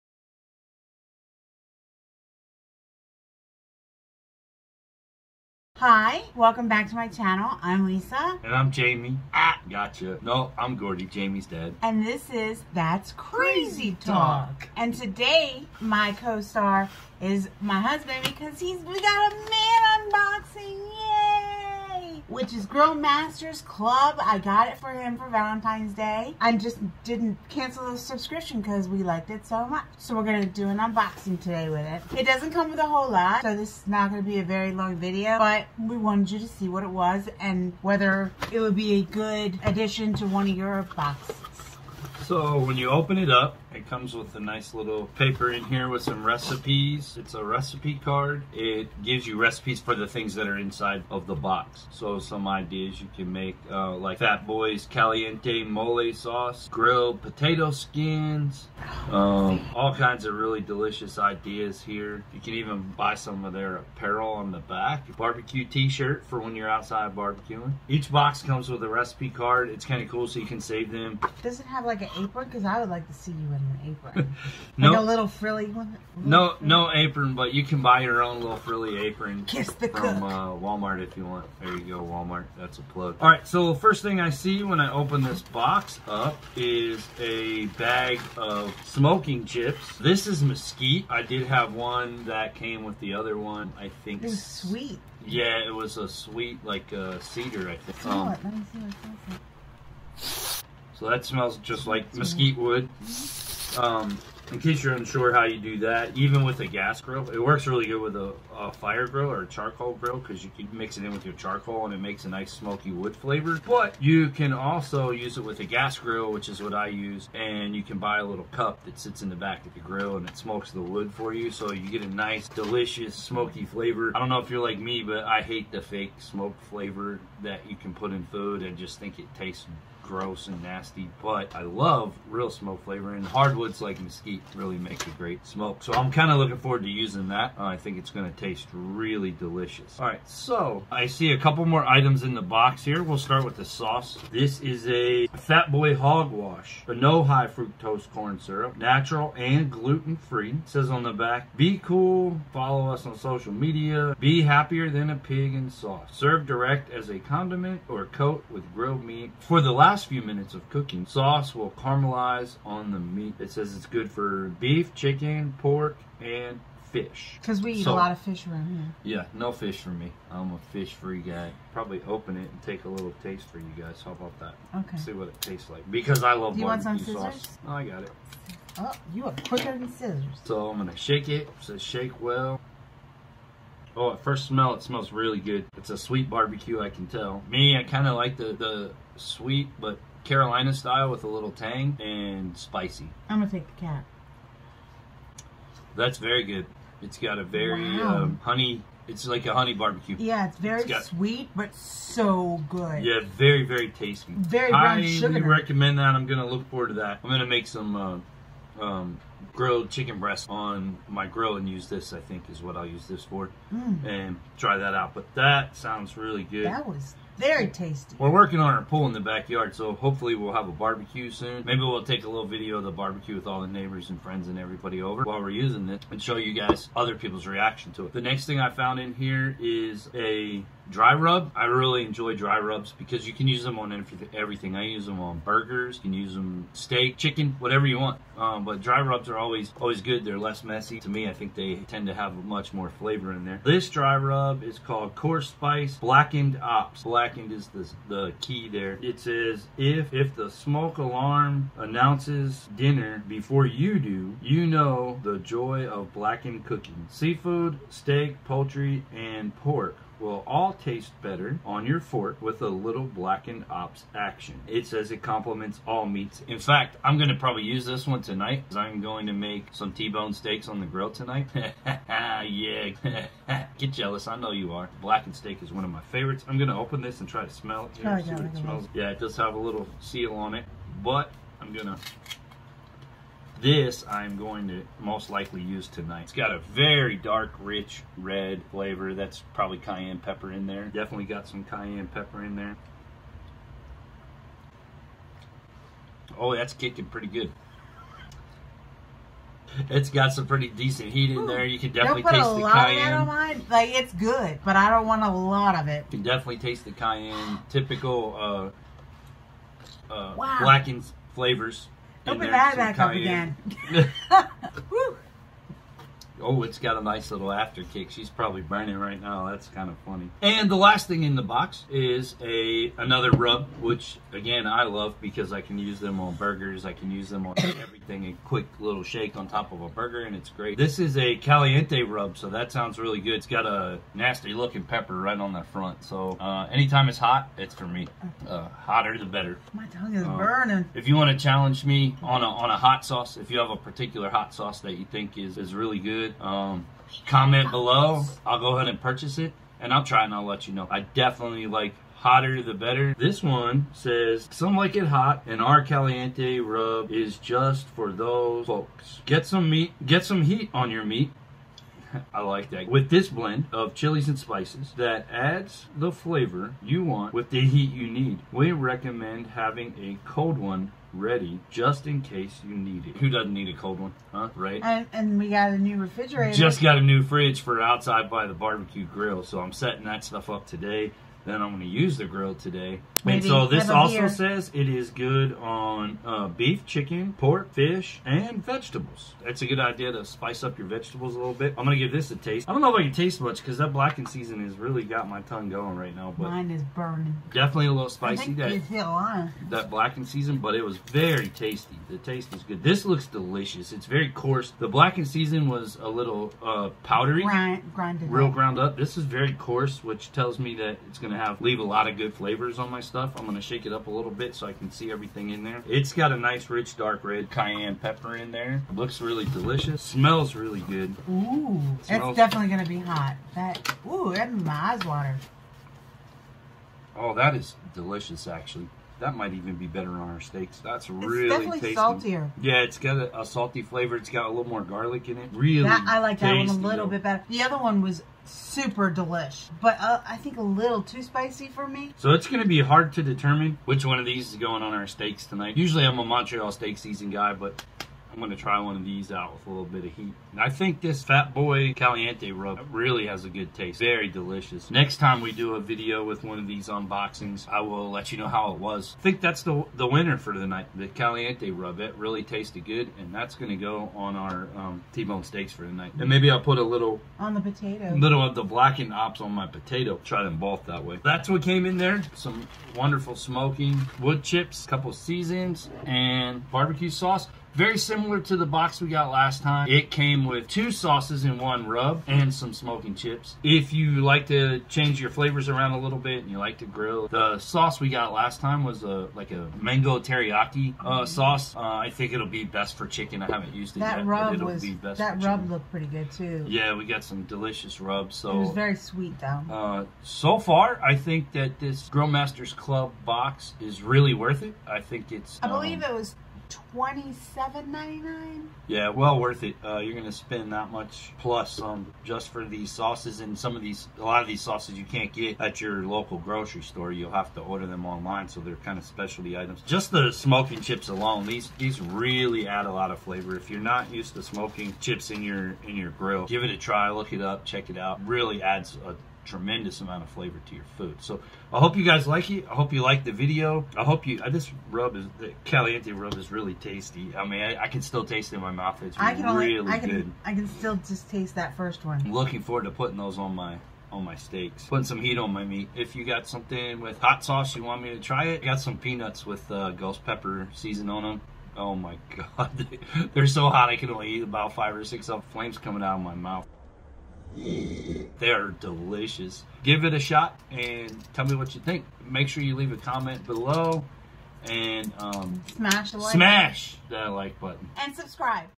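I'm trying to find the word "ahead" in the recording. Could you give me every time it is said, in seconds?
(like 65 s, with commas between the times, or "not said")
348 s.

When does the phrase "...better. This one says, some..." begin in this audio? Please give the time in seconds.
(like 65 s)
352 s.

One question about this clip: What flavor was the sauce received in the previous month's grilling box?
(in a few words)
Mango teriyaki.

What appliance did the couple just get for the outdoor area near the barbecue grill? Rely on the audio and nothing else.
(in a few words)
Refrigerator.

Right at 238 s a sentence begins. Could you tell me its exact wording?
Um, but dry rubs are always always good.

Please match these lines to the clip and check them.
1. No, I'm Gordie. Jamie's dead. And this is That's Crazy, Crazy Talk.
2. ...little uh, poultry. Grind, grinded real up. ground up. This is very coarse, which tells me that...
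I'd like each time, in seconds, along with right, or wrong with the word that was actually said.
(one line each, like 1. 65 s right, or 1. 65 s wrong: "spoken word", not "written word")
1. 10 s right
2. 406 s wrong: "powdery", not "poultry".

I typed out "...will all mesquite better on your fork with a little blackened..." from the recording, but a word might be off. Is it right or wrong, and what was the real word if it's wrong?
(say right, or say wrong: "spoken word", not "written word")
wrong: "taste", not "mesquite".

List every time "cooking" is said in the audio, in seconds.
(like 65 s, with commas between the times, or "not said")
160 s, 256 s.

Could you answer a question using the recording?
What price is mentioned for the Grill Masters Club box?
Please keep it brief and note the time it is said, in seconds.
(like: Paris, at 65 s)
$27.99, at 506 s.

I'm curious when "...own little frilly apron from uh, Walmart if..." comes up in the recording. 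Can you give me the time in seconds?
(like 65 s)
78 s.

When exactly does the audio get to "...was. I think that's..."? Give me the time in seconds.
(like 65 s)
458 s.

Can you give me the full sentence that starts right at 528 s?
Really adds a tremendous amount of flavor to your food.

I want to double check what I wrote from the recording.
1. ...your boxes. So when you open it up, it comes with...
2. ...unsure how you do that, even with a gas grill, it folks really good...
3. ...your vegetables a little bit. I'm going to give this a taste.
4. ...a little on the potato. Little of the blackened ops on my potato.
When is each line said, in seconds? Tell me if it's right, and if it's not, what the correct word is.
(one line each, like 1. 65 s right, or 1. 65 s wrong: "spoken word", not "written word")
1. 40 s right
2. 104 s wrong: "works", not "folks"
3. 390 s right
4. 466 s right.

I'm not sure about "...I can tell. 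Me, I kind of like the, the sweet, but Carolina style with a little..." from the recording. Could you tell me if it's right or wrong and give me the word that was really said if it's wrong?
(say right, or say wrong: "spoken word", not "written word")
right.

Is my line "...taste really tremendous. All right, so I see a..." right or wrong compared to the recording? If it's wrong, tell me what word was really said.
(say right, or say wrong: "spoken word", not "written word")
wrong: "delicious", not "tremendous".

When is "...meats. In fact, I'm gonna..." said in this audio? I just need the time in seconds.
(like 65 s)
266 s.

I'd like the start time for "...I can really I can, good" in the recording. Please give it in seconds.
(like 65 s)
539 s.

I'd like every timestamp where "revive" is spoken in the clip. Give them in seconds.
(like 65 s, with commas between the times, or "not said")
not said.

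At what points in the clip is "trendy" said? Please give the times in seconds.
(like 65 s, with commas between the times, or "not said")
not said.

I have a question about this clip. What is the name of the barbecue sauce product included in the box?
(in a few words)
Fat Boy Hog Wash.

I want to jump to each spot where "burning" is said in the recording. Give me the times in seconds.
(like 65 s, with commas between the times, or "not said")
318 s, 340 s, 396 s.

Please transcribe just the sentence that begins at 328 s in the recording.
A quick little shake on top of a burger, and it's great.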